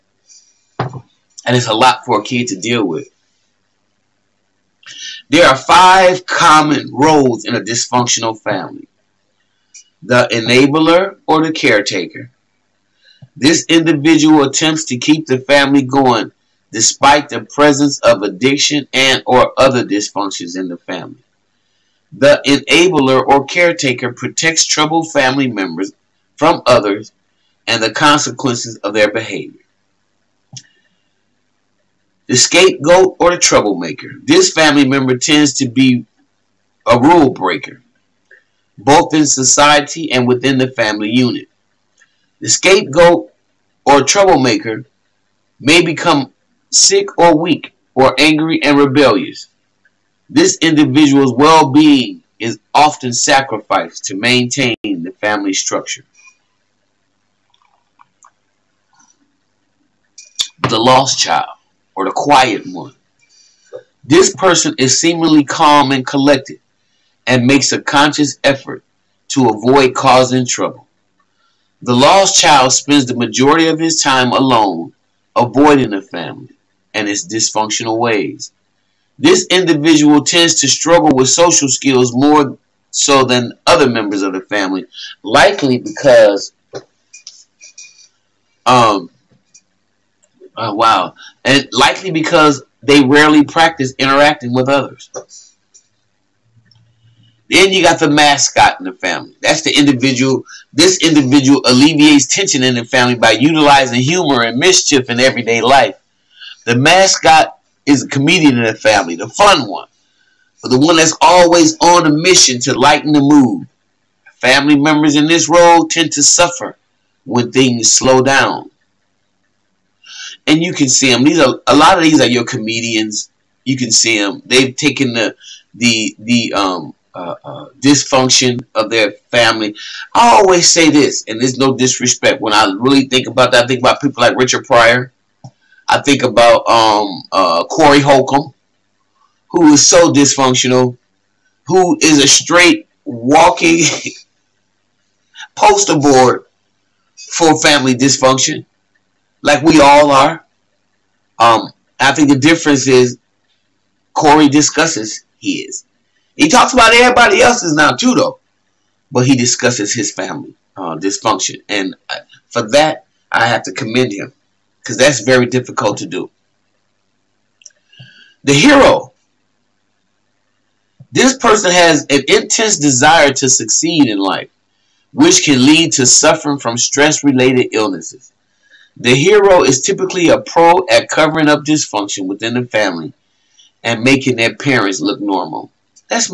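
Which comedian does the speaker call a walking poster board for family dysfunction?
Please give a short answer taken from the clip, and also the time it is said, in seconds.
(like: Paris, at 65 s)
Corey Holcomb, at 137 s.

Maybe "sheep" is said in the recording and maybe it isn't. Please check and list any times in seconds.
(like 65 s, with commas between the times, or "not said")
not said.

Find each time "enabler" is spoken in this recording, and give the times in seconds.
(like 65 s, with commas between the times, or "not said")
10 s, 22 s.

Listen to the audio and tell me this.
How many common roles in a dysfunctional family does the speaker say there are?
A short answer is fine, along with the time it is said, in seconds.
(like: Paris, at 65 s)
5, at 5 s.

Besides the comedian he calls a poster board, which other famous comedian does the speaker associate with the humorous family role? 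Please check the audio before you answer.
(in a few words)
Richard Pryor.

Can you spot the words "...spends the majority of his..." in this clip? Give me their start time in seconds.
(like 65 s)
72 s.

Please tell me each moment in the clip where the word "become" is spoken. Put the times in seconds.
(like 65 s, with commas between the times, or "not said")
45 s.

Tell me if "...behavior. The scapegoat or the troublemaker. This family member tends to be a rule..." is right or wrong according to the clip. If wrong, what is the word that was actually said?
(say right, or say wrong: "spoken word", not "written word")
right.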